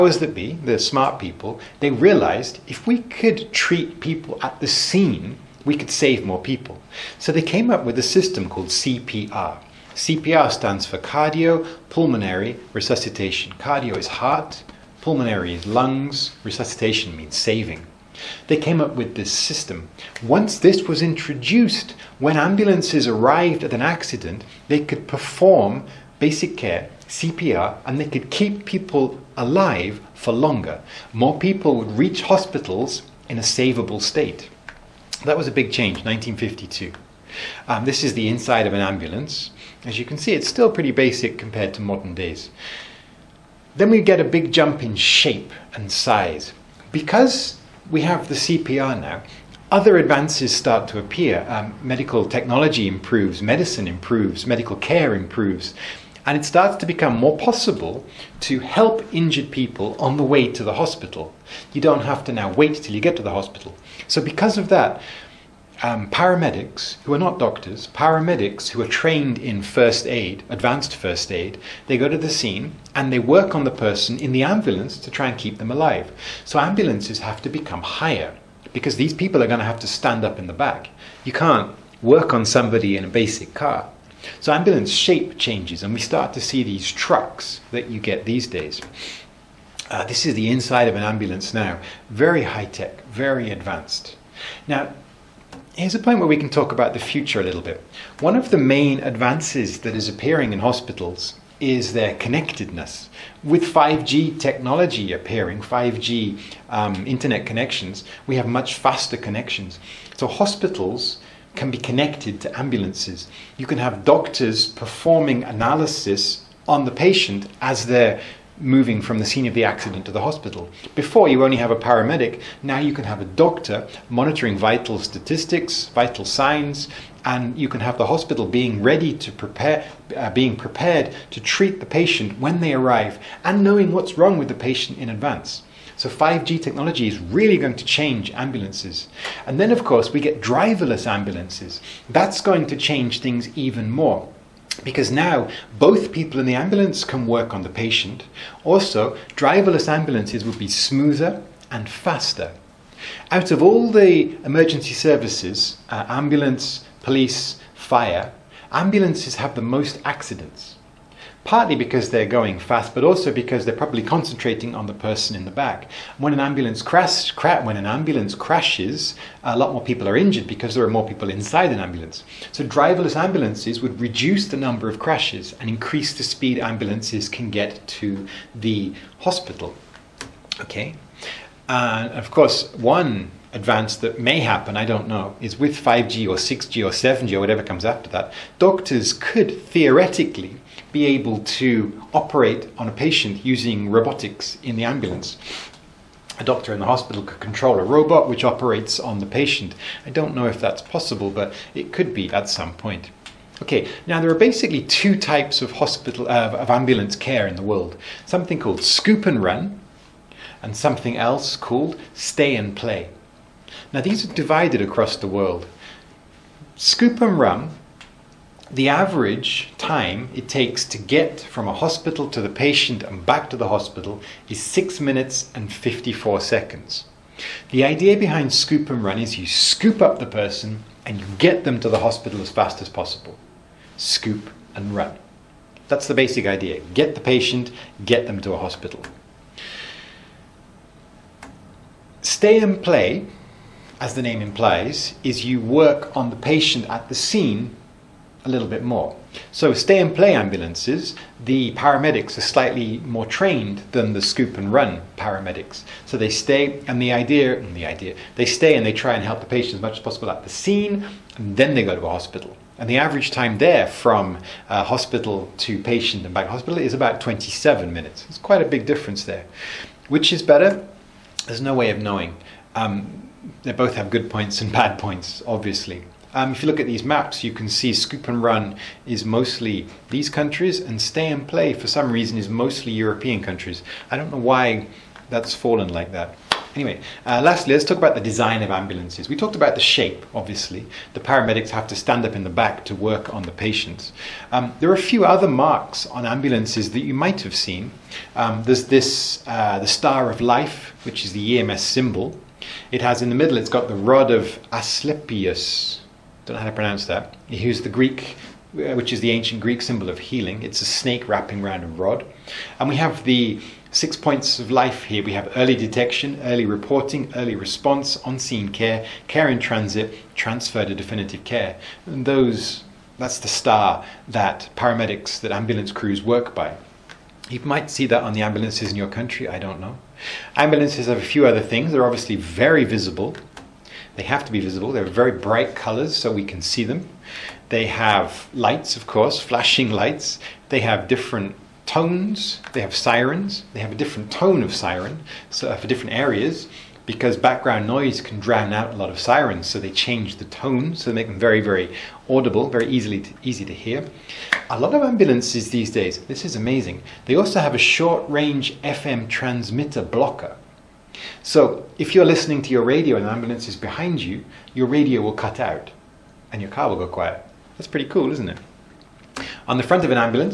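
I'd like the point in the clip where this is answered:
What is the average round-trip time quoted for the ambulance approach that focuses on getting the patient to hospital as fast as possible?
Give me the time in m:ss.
3:44.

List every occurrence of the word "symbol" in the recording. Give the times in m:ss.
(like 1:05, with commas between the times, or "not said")
5:01, 5:09.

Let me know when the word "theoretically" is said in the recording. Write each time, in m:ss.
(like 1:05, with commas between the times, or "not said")
3:09.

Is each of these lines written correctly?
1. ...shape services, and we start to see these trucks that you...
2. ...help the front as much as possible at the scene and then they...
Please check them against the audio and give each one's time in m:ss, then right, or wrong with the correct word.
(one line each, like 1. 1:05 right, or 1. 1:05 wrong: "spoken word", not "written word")
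1. 1:24 wrong: "changes", not "services"
2. 4:19 wrong: "patient", not "front".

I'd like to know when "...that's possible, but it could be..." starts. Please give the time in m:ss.
3:20.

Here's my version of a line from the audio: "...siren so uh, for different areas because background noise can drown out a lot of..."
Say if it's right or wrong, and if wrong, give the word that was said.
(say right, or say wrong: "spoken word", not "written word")
right.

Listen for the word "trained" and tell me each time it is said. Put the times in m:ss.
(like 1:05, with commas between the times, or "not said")
1:08, 4:13.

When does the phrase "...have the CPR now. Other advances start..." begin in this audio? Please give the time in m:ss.
0:48.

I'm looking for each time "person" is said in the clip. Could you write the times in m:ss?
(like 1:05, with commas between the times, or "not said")
1:13, 2:44, 3:50.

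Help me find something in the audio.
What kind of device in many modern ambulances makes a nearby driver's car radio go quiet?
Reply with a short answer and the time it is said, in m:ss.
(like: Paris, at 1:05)
Short range FM transmitter blocker, at 5:57.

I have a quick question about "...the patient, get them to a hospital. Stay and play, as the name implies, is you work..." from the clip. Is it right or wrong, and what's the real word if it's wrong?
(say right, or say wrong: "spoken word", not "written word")
right.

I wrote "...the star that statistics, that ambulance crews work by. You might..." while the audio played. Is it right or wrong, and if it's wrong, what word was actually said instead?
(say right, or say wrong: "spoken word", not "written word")
wrong: "paramedics", not "statistics".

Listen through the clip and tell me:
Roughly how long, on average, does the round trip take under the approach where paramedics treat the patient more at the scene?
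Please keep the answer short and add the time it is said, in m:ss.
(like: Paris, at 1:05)
About 27 minutes, at 4:27.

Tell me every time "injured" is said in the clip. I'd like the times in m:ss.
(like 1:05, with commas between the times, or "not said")
0:59, 2:50.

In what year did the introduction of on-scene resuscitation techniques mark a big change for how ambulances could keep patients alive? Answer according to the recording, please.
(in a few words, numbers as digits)
1952.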